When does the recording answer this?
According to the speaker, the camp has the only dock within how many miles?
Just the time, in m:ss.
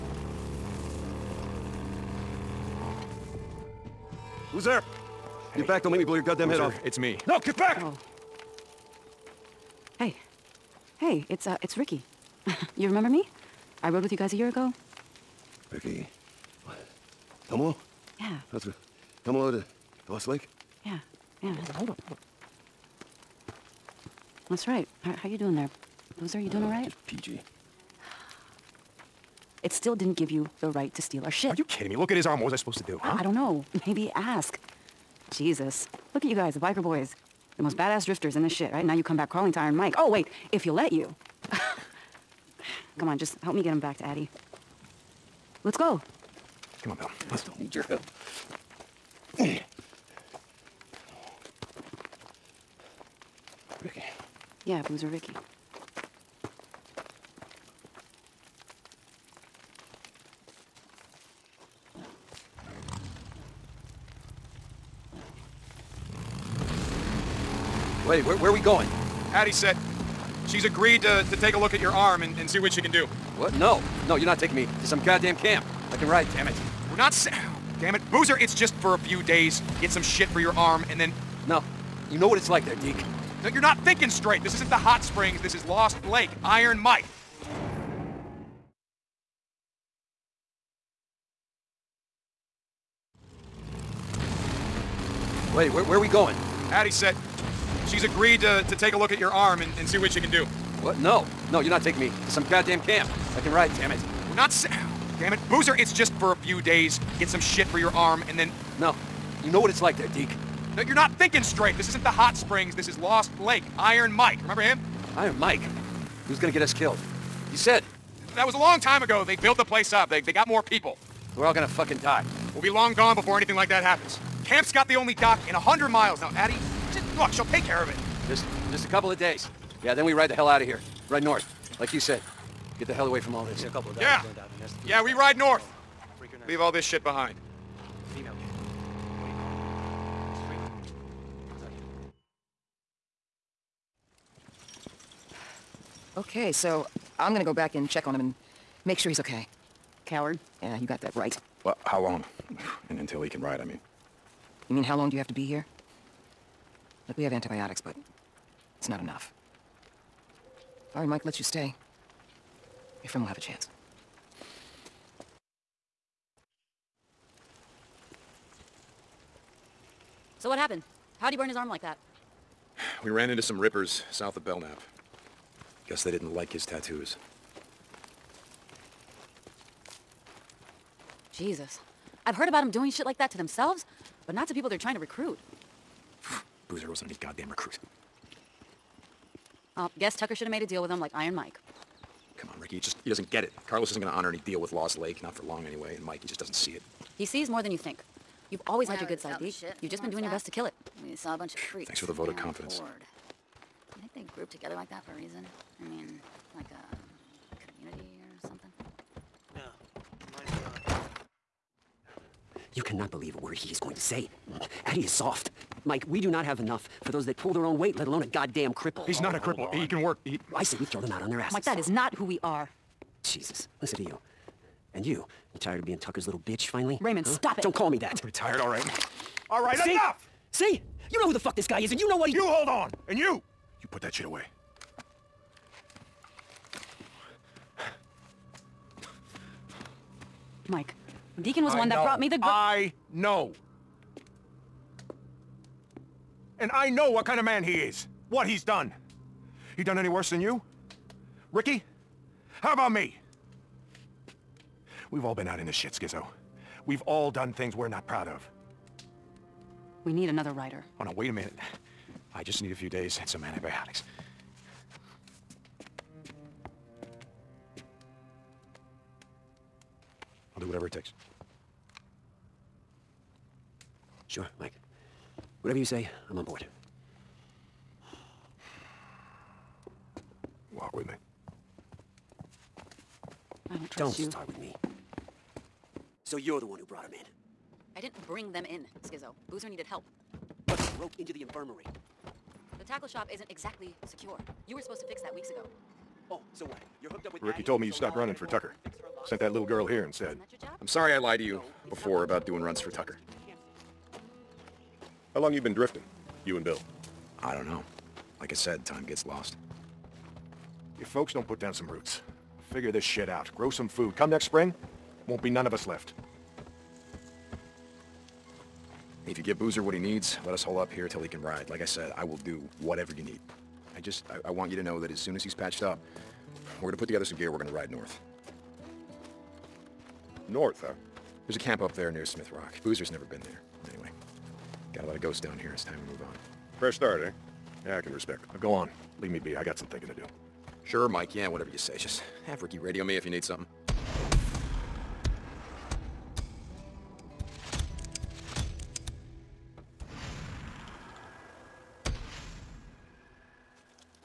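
2:05.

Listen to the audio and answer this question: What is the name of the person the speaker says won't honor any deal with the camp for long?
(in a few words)
Carlos.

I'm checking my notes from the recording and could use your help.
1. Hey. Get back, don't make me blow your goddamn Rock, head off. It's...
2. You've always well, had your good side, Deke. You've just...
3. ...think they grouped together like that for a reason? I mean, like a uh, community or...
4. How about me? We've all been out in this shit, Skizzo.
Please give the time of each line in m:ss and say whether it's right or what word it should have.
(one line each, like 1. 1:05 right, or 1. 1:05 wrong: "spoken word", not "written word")
1. 0:05 wrong: "Loser", not "Rock"
2. 3:18 right
3. 3:24 right
4. 4:12 right.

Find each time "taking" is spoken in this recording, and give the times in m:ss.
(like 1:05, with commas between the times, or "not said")
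1:14, 1:41.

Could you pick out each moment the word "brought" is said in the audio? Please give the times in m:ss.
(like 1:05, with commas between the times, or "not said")
4:02, 4:46.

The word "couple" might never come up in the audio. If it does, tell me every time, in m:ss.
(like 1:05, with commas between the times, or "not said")
2:08, 2:13.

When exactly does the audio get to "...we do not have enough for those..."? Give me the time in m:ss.
3:36.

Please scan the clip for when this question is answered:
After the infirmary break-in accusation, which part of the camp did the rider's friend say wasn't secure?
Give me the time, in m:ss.
4:52.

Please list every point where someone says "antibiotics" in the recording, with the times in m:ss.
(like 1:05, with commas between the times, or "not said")
2:37, 4:23.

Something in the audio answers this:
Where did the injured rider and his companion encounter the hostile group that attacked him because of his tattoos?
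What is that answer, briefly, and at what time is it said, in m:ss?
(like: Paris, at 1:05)
South of Belknap, at 2:54.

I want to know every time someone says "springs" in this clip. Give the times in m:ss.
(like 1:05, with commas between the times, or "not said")
1:25, 1:52, 5:14.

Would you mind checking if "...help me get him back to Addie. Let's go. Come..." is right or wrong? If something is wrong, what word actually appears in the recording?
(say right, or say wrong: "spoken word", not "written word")
right.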